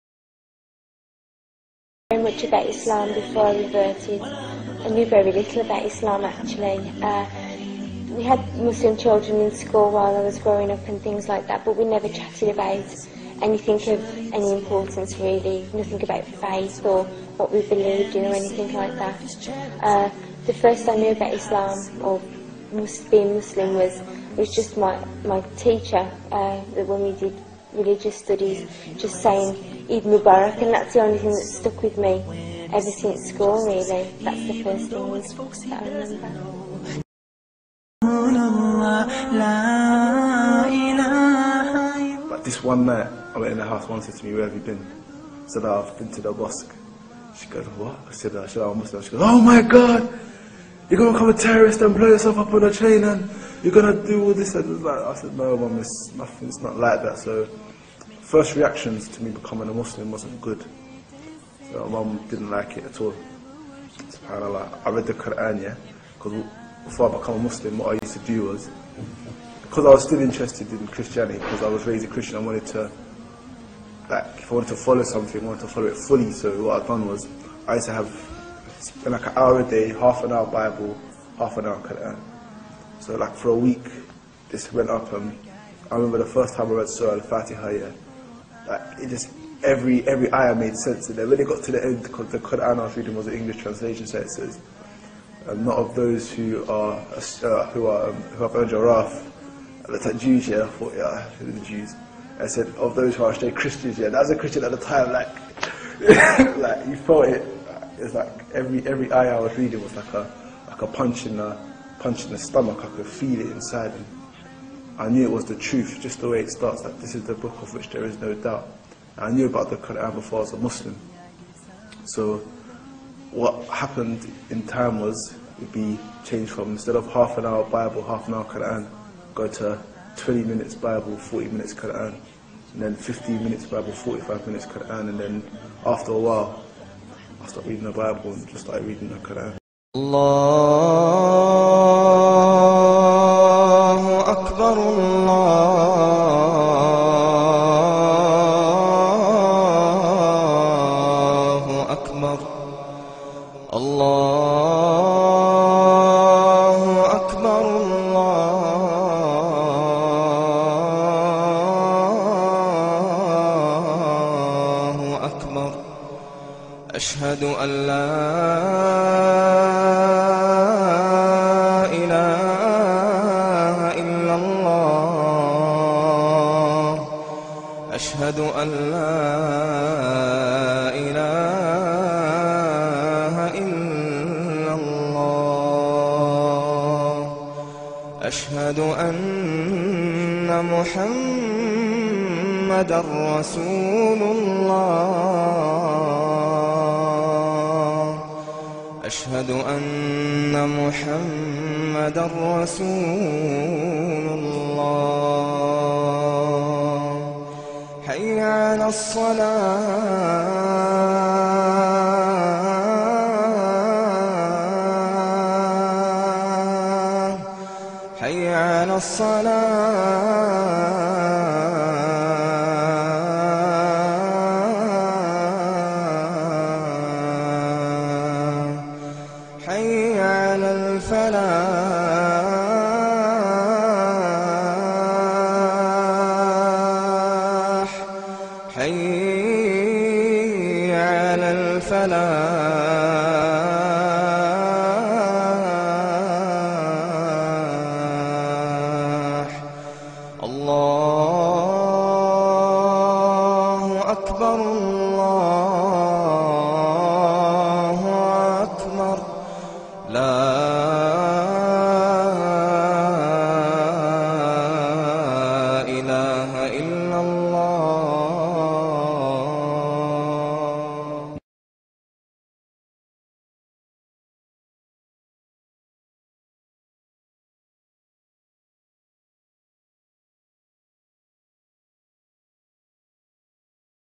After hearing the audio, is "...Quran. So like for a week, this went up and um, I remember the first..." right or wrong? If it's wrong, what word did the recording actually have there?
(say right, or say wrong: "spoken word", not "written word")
right.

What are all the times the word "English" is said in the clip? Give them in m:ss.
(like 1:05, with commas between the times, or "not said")
1:33.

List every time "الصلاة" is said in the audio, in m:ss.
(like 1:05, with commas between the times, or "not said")
3:28, 3:38.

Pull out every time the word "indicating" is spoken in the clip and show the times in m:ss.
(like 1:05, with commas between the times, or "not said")
not said.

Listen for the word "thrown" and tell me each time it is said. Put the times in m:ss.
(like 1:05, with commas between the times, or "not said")
not said.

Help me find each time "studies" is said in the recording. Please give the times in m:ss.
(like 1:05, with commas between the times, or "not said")
0:28.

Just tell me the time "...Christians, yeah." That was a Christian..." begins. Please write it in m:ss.
1:43.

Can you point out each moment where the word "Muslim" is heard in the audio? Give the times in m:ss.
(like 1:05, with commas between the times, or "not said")
0:08, 0:23, 0:48, 0:59, 1:07, 2:00.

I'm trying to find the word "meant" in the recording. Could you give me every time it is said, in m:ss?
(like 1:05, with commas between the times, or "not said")
not said.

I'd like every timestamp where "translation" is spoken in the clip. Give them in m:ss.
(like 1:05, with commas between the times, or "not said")
1:33.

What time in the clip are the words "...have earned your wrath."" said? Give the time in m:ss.
1:38.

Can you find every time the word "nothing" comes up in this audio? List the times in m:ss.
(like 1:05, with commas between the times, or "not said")
0:15, 0:56.